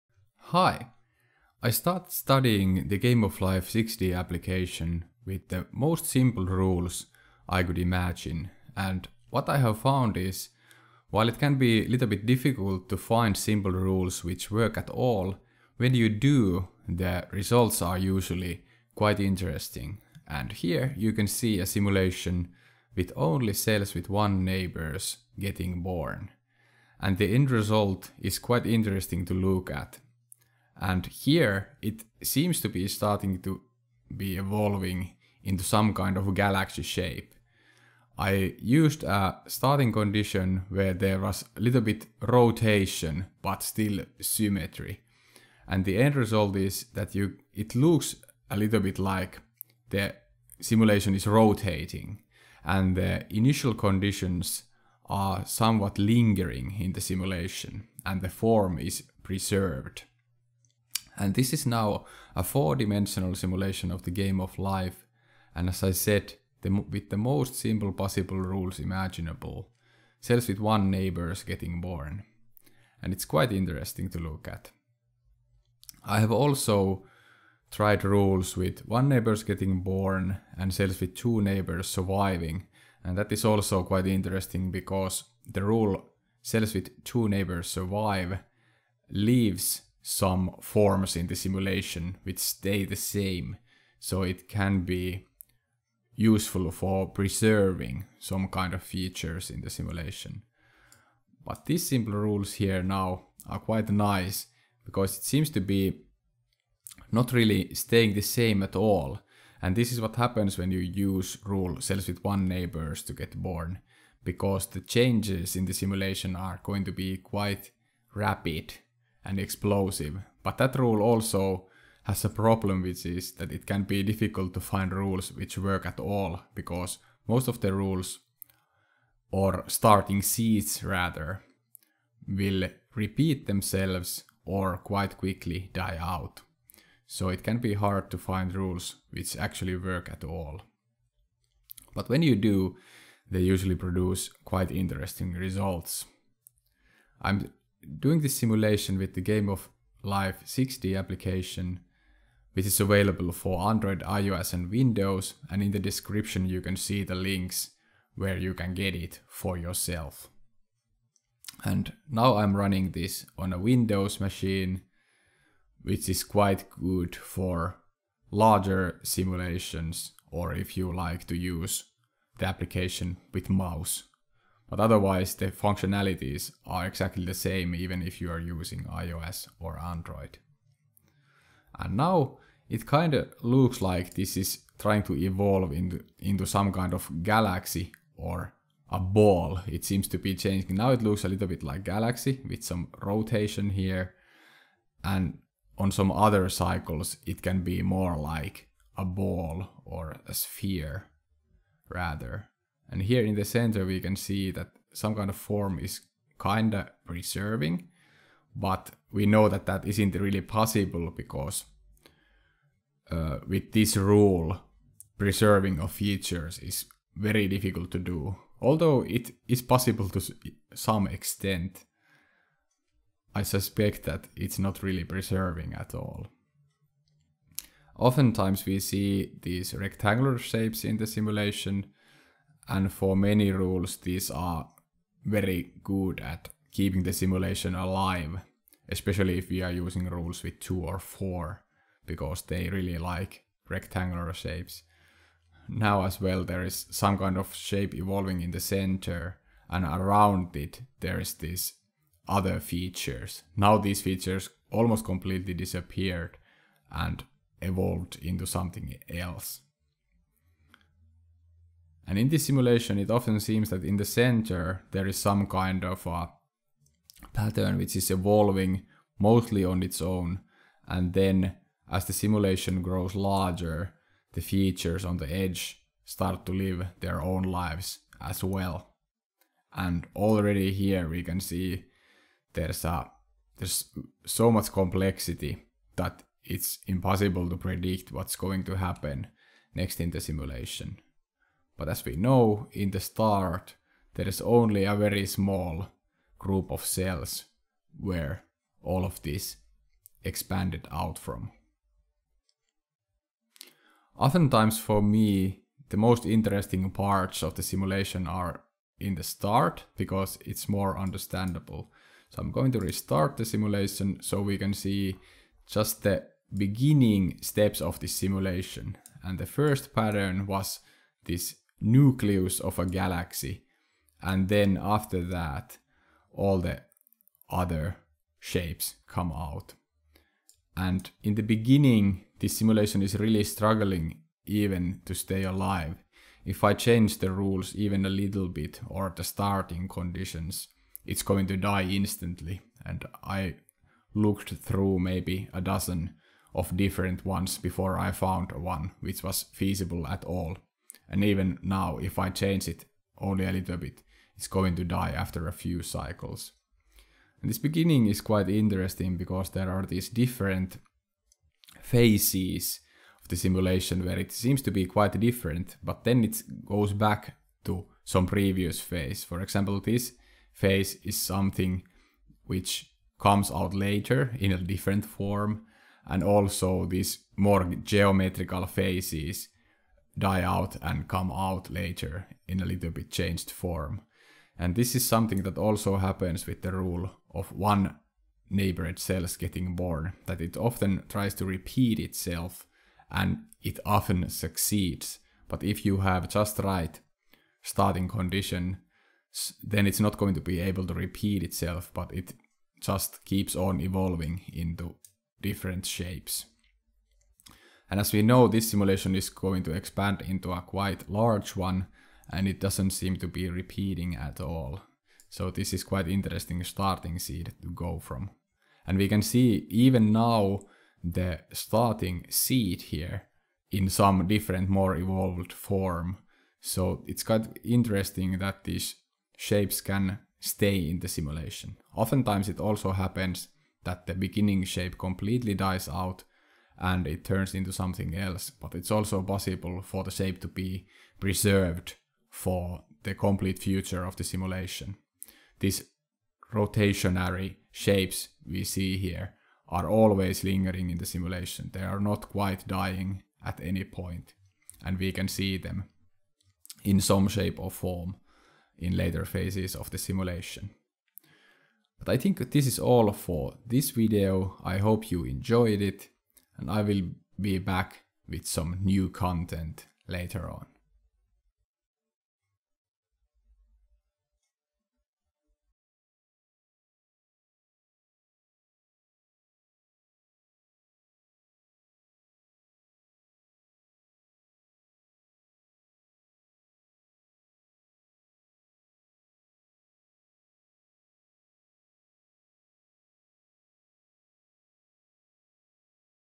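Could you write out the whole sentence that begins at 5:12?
So I'm going to restart the simulation so we can see just the beginning steps of this simulation.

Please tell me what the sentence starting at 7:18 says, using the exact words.
But it's also possible for the shape to be preserved for the complete future of the simulation.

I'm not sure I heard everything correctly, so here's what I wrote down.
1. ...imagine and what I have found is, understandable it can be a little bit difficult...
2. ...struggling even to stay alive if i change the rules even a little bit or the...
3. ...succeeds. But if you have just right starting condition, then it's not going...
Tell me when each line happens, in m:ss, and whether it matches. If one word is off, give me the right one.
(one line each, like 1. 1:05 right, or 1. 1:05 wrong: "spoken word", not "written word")
1. 0:07 wrong: "while", not "understandable"
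2. 5:33 right
3. 6:34 right.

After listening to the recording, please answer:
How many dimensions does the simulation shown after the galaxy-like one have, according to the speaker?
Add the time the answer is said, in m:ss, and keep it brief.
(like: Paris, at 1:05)
4, at 1:02.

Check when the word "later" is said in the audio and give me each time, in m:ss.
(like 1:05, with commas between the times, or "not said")
6:13, 6:21, 7:38, 7:50.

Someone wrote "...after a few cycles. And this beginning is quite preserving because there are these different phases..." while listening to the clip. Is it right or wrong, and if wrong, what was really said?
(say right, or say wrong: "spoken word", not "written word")
wrong: "interesting", not "preserving".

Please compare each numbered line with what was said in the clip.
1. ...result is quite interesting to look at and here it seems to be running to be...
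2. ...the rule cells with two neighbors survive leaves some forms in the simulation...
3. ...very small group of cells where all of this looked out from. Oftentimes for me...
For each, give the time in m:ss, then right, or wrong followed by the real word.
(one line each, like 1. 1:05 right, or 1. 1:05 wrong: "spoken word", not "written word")
1. 0:27 wrong: "starting", not "running"
2. 1:25 right
3. 4:54 wrong: "expanded", not "looked".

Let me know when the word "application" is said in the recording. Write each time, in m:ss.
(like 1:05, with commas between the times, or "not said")
0:04, 2:30, 2:52.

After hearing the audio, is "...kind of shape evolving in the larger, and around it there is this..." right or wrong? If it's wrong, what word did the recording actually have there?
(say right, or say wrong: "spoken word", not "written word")
wrong: "center", not "larger".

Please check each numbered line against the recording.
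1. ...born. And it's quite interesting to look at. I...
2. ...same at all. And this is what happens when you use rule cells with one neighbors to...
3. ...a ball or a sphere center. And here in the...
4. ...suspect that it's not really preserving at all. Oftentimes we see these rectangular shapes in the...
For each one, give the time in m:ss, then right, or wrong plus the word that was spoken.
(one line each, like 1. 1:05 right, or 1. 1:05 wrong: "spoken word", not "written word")
1. 1:11 right
2. 1:48 right
3. 3:18 wrong: "rather", not "center"
4. 3:43 right.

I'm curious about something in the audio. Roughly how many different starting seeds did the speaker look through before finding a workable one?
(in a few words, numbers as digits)
A dozen.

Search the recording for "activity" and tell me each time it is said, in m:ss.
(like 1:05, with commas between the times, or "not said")
not said.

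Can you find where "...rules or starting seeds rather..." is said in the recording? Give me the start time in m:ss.
2:07.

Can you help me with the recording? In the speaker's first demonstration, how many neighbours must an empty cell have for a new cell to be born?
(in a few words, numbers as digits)
1.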